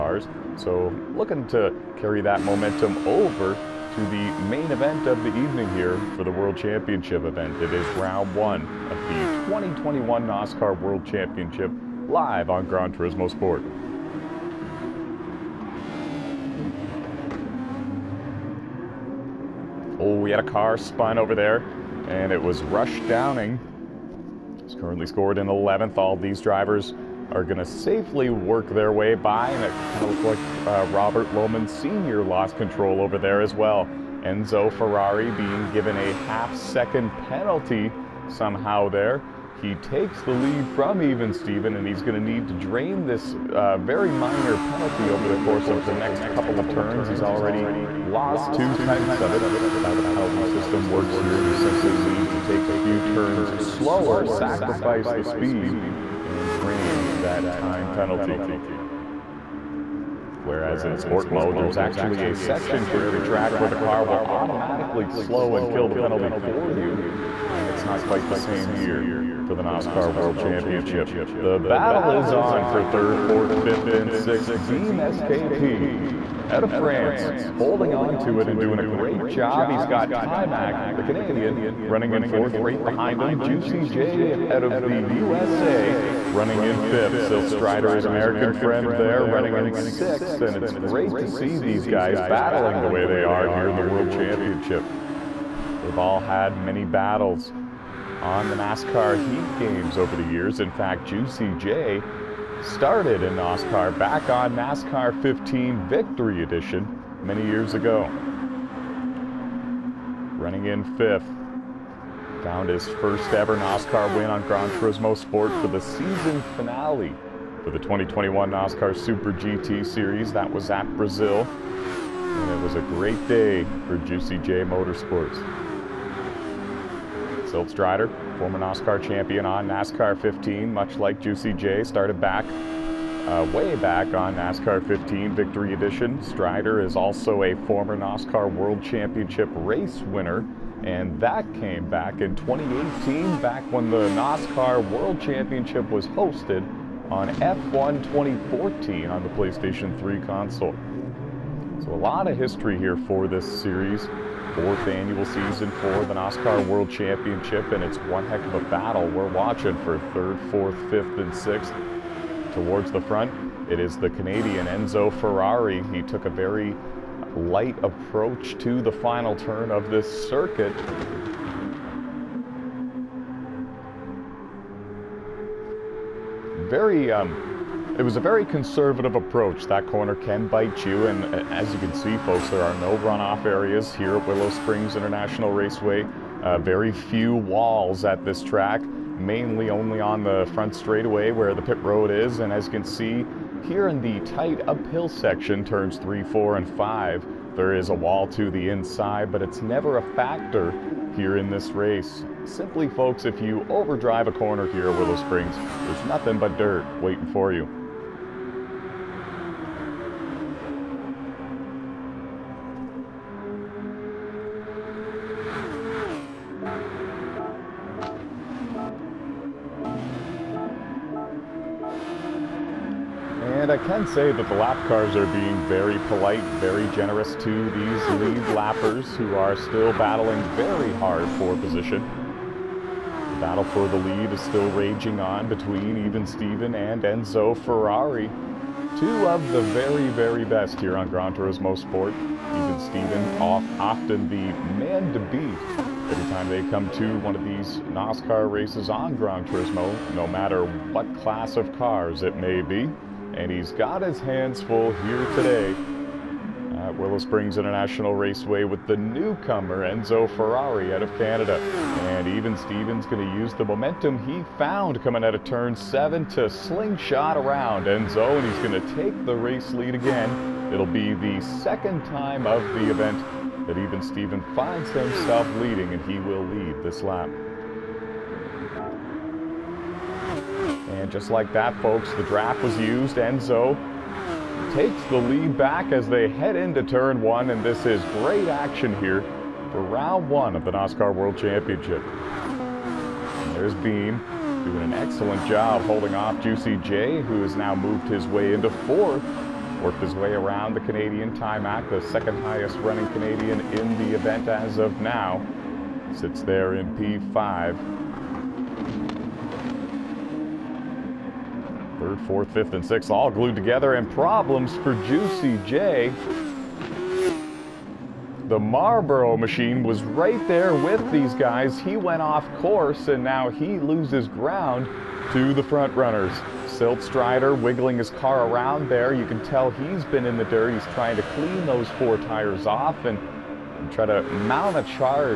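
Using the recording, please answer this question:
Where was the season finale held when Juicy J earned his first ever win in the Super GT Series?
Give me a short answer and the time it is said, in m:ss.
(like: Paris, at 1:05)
Brazil, at 2:00.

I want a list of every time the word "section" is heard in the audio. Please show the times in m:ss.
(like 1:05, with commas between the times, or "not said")
1:02, 3:15.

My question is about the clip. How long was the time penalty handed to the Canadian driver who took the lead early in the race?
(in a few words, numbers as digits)
half second.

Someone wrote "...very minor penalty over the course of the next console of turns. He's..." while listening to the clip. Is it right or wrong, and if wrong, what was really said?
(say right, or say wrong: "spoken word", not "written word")
wrong: "couple", not "console".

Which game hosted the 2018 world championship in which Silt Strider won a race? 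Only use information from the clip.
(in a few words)
F1 2014.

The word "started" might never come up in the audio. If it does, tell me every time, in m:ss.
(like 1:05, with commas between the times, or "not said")
1:42, 2:11.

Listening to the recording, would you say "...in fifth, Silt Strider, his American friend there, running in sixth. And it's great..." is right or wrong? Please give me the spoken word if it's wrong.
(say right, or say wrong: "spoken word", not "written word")
right.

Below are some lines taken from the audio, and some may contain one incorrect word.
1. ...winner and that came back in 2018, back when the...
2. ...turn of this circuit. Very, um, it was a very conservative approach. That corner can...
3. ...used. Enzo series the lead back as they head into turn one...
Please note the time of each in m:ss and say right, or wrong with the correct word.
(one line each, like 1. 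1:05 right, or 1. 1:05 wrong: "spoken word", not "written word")
1. 2:20 right
2. 2:49 right
3. 4:42 wrong: "takes", not "series".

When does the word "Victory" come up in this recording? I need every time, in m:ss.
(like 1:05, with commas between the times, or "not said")
1:45, 2:15.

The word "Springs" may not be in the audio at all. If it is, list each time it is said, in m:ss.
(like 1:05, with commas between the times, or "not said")
3:04, 3:25, 4:17.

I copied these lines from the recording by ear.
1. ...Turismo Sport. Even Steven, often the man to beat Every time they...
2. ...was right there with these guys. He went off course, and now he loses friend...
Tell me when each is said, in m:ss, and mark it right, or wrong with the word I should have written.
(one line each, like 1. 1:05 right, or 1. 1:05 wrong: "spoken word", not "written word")
1. 4:01 right
2. 5:19 wrong: "ground", not "friend".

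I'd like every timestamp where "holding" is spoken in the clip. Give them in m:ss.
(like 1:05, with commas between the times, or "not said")
1:17, 4:55.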